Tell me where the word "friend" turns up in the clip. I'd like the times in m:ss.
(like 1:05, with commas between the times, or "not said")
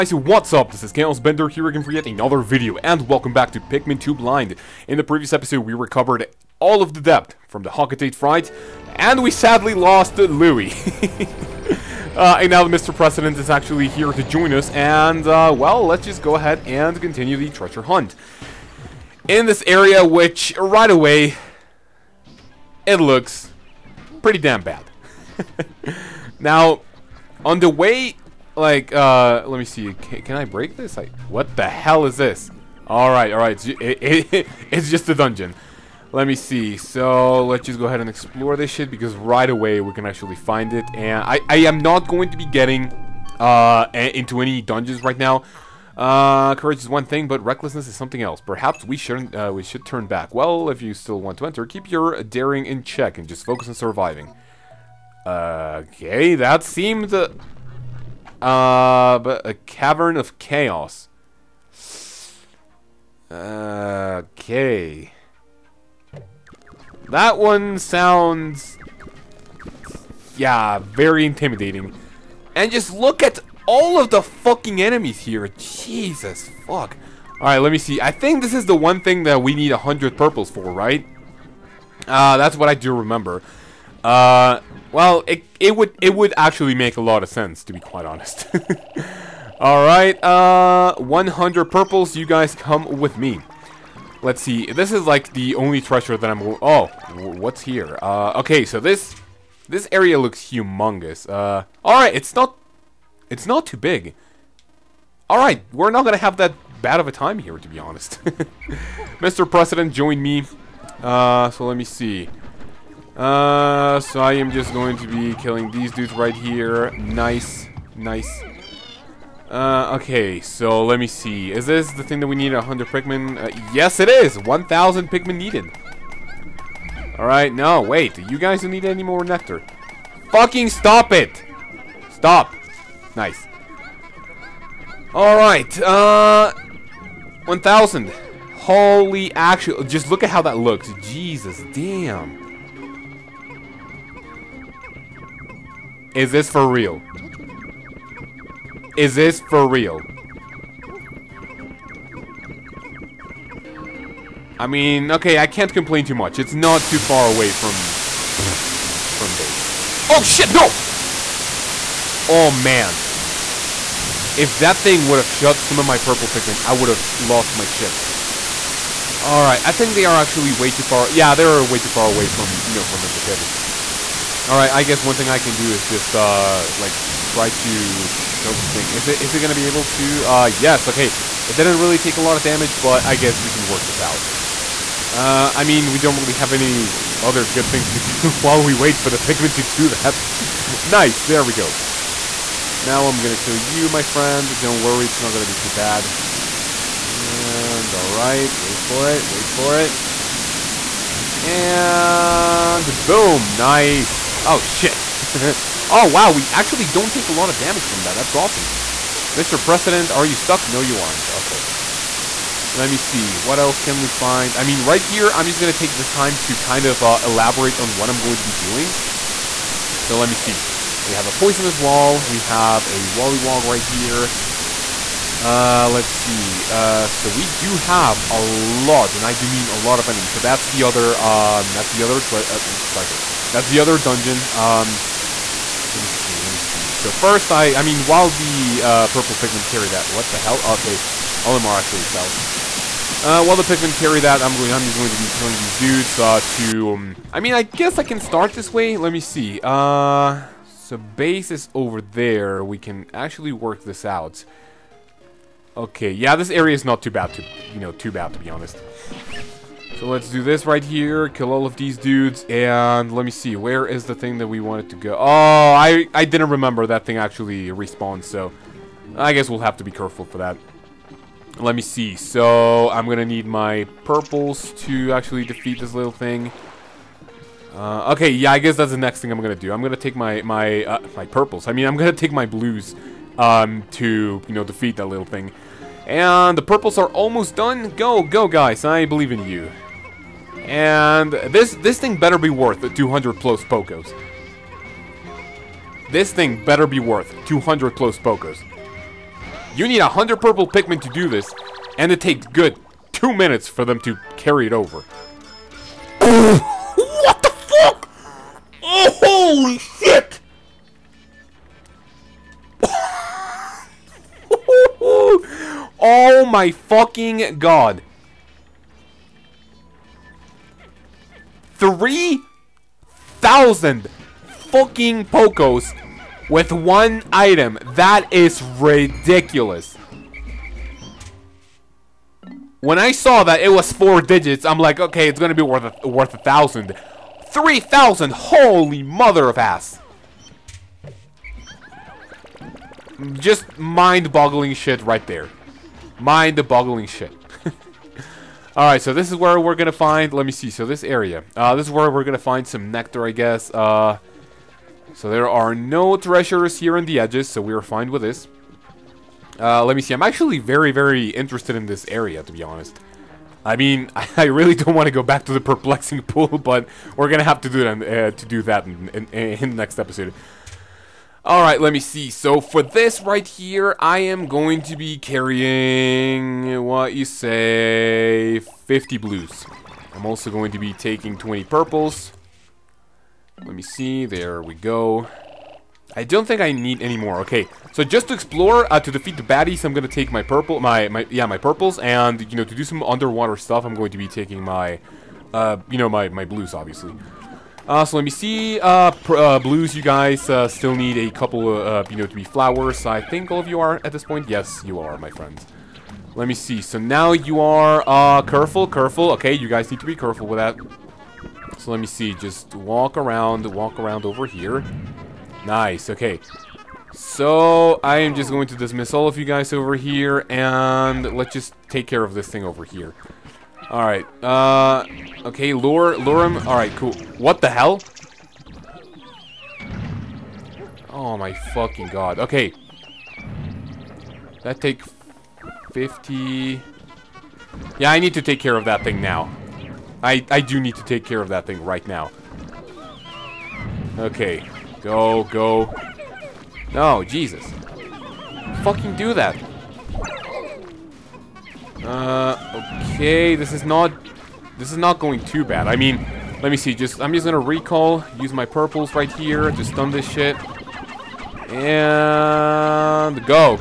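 3:14, 6:45.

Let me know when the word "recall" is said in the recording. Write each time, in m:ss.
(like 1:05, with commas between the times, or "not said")
7:37.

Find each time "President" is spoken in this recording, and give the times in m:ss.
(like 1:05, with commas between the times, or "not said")
0:12, 1:49, 3:29.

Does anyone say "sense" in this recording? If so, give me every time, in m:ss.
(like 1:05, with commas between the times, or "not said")
1:27.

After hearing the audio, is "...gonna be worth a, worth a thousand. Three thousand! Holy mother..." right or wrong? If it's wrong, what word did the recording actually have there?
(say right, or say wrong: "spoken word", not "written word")
right.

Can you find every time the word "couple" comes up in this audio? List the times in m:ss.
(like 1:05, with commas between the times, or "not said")
6:41.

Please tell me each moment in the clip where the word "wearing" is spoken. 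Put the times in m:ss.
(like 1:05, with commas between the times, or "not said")
not said.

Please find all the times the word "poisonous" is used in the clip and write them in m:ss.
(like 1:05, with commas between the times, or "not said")
3:41.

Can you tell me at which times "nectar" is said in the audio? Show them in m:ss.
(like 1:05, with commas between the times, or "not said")
2:09, 5:52.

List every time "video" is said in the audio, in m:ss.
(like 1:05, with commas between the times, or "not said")
0:02.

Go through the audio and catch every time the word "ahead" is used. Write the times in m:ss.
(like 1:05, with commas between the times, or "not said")
0:16, 0:37.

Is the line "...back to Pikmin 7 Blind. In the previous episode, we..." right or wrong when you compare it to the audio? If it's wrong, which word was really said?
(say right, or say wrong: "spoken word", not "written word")
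wrong: "2", not "7".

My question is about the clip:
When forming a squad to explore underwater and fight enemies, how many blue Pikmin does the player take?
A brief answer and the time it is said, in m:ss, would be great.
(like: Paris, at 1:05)
50, at 6:18.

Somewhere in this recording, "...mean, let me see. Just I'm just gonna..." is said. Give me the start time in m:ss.
7:35.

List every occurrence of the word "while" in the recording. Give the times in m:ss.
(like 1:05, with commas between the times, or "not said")
3:08, 3:58, 4:03.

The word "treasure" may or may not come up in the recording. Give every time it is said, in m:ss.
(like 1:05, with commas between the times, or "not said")
0:17, 1:35, 3:52, 5:56.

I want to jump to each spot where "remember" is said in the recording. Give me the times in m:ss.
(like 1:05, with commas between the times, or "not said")
1:22, 4:26.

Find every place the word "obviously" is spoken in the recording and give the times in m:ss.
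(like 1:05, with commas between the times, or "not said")
6:36.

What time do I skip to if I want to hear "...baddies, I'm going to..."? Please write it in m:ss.
6:29.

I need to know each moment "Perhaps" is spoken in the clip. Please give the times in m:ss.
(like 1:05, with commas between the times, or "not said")
0:48.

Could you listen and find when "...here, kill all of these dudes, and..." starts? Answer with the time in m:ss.
4:20.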